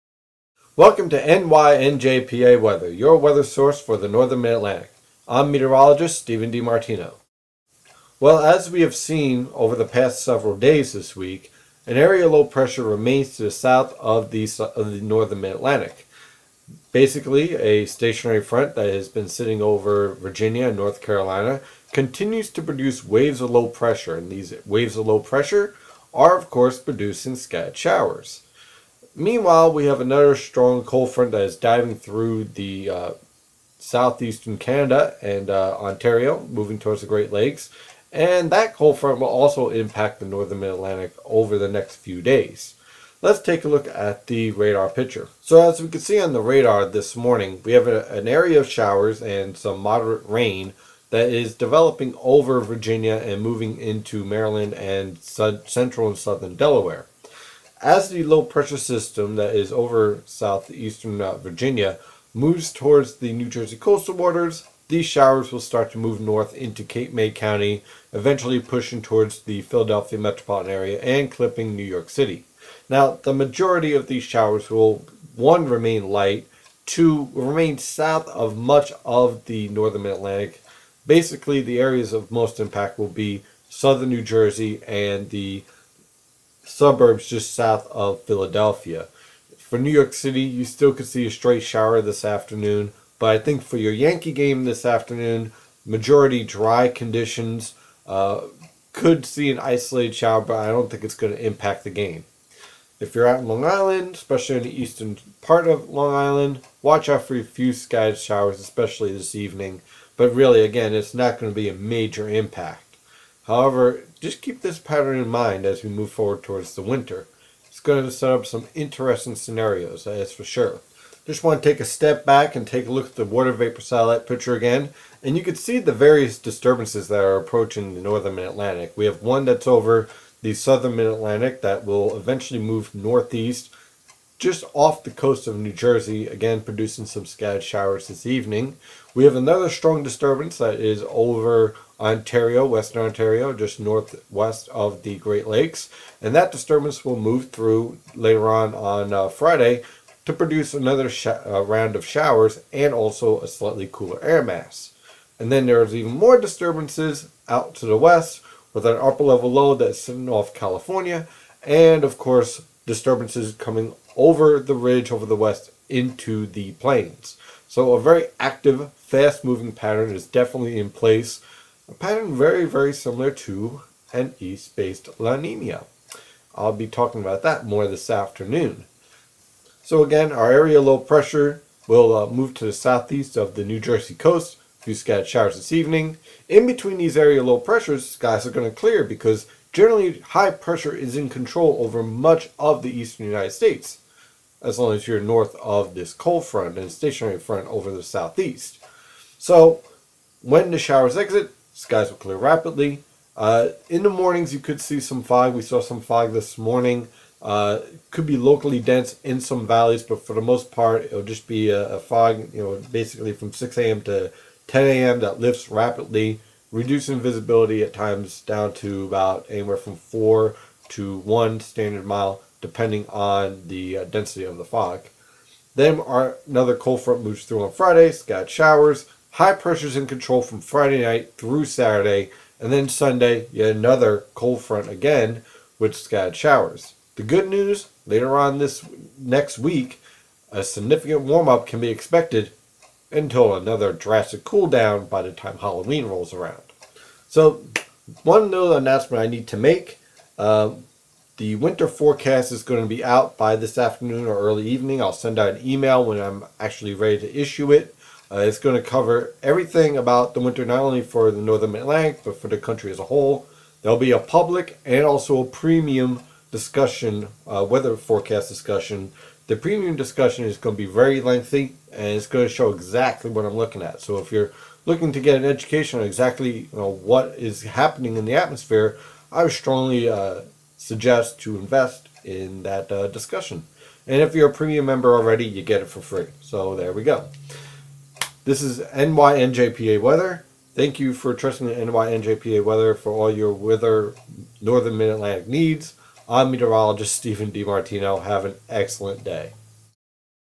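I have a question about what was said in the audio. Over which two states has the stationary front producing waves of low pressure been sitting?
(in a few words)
Virginia and North Carolina.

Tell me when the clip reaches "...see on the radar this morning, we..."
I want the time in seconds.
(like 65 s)
46 s.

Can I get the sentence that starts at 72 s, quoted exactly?
Now, the majority of these showers will, one, remain light, two, remain south of much of the northern Atlantic.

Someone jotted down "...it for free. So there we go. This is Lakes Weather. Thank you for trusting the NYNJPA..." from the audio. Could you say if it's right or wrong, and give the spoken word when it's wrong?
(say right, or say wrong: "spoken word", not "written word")
wrong: "NYNJPA", not "Lakes".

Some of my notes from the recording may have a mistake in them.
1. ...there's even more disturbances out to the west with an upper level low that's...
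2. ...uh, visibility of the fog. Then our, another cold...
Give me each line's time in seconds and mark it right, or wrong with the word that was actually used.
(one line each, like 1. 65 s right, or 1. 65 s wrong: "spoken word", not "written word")
1. 155 s right
2. 223 s wrong: "density", not "visibility".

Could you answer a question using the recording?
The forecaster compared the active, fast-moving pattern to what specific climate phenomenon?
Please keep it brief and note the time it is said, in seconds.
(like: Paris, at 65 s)
East-based La Nina, at 174 s.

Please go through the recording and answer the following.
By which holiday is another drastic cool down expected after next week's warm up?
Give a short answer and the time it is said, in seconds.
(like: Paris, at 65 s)
Halloween, at 245 s.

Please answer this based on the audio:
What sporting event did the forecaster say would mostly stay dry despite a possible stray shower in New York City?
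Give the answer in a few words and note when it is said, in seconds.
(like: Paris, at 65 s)
Yankee game, at 93 s.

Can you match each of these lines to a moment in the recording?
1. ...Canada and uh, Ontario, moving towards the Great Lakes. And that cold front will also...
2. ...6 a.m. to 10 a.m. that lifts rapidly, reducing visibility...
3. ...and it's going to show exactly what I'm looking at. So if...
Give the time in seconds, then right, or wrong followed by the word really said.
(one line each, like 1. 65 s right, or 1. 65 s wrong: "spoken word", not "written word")
1. 34 s right
2. 213 s right
3. 271 s right.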